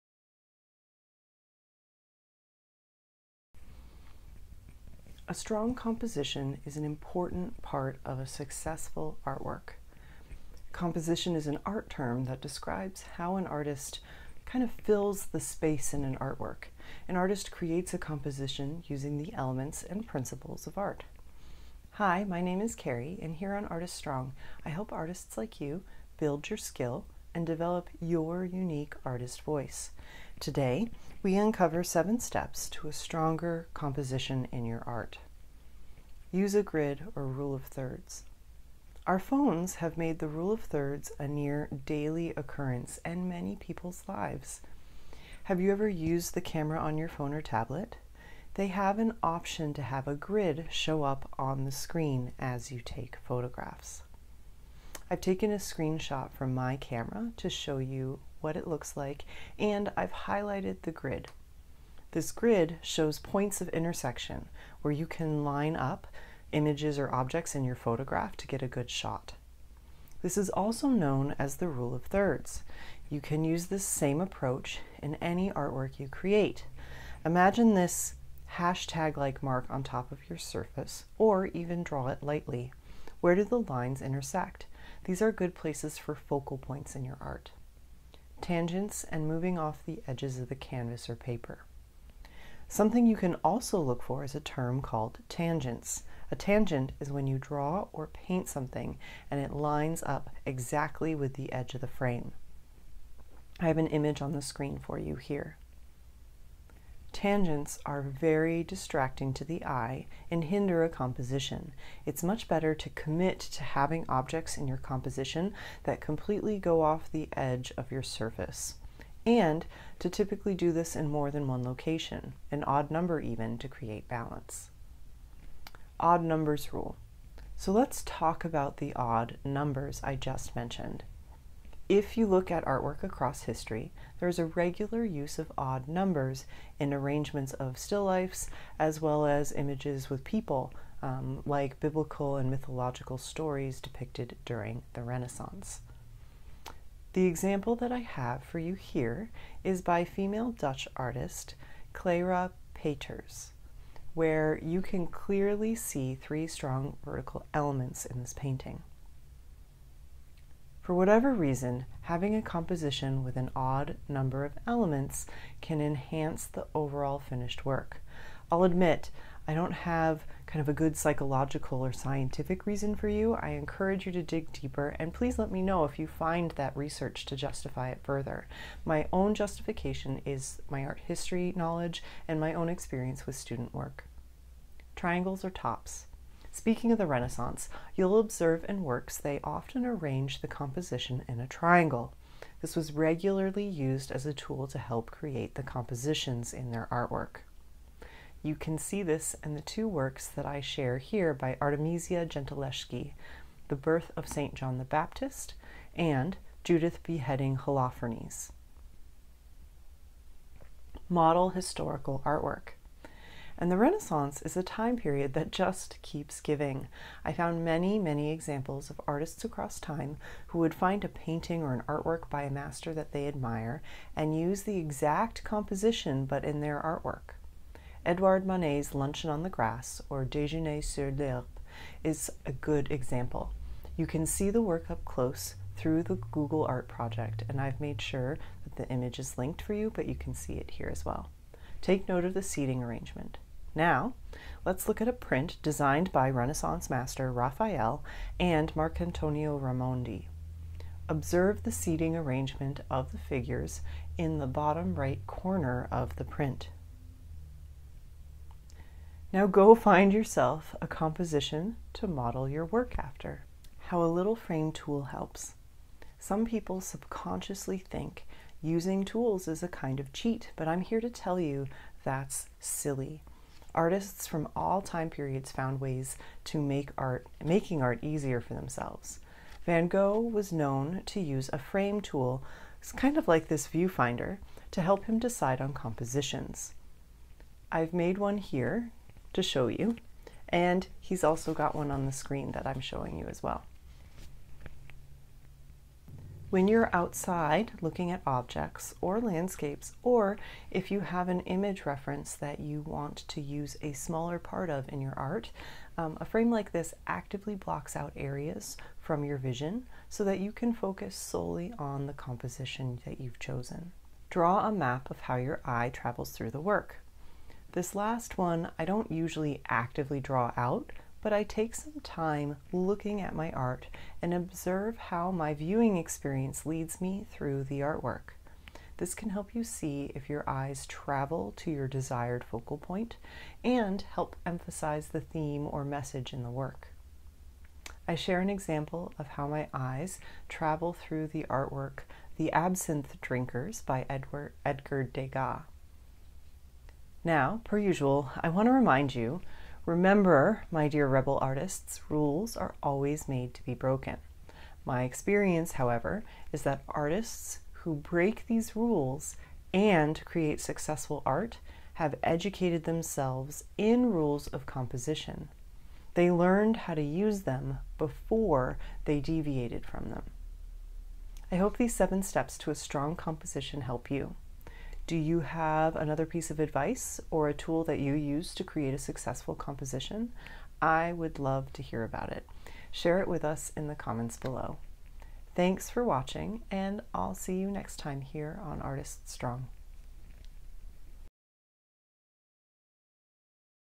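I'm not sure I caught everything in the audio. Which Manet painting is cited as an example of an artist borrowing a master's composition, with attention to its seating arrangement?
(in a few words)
Luncheon on the Grass.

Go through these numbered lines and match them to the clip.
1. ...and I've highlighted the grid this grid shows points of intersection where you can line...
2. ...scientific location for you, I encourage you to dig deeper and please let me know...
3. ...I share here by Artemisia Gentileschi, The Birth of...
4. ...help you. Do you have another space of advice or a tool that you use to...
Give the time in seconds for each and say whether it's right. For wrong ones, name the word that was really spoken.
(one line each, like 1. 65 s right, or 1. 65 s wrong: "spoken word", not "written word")
1. 59 s right
2. 171 s wrong: "reason", not "location"
3. 200 s right
4. 373 s wrong: "piece", not "space".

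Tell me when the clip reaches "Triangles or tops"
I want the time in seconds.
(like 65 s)
184 s.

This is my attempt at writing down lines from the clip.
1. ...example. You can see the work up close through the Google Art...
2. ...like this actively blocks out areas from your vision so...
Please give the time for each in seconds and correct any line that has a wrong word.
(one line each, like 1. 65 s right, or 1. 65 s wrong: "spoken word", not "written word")
1. 232 s right
2. 306 s right.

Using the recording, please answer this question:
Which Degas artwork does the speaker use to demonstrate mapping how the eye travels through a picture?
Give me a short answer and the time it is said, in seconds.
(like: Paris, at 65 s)
The Absinthe Drinkers, at 342 s.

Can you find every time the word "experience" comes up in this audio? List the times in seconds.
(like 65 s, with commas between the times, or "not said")
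182 s, 325 s, 355 s.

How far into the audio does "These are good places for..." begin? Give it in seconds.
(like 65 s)
85 s.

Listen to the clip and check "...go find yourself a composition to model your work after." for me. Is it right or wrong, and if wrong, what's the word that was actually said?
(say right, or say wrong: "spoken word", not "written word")
right.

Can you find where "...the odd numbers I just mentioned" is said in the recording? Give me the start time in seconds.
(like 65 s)
128 s.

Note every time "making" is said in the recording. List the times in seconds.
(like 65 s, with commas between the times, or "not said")
277 s.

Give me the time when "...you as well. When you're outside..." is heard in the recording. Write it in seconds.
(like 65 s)
293 s.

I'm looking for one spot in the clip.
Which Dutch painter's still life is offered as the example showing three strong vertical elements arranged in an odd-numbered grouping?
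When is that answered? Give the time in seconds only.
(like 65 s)
151 s.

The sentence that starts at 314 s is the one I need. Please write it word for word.
Draw a map of how your eye travels through the work.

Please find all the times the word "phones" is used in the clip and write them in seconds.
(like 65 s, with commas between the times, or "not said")
39 s, 47 s.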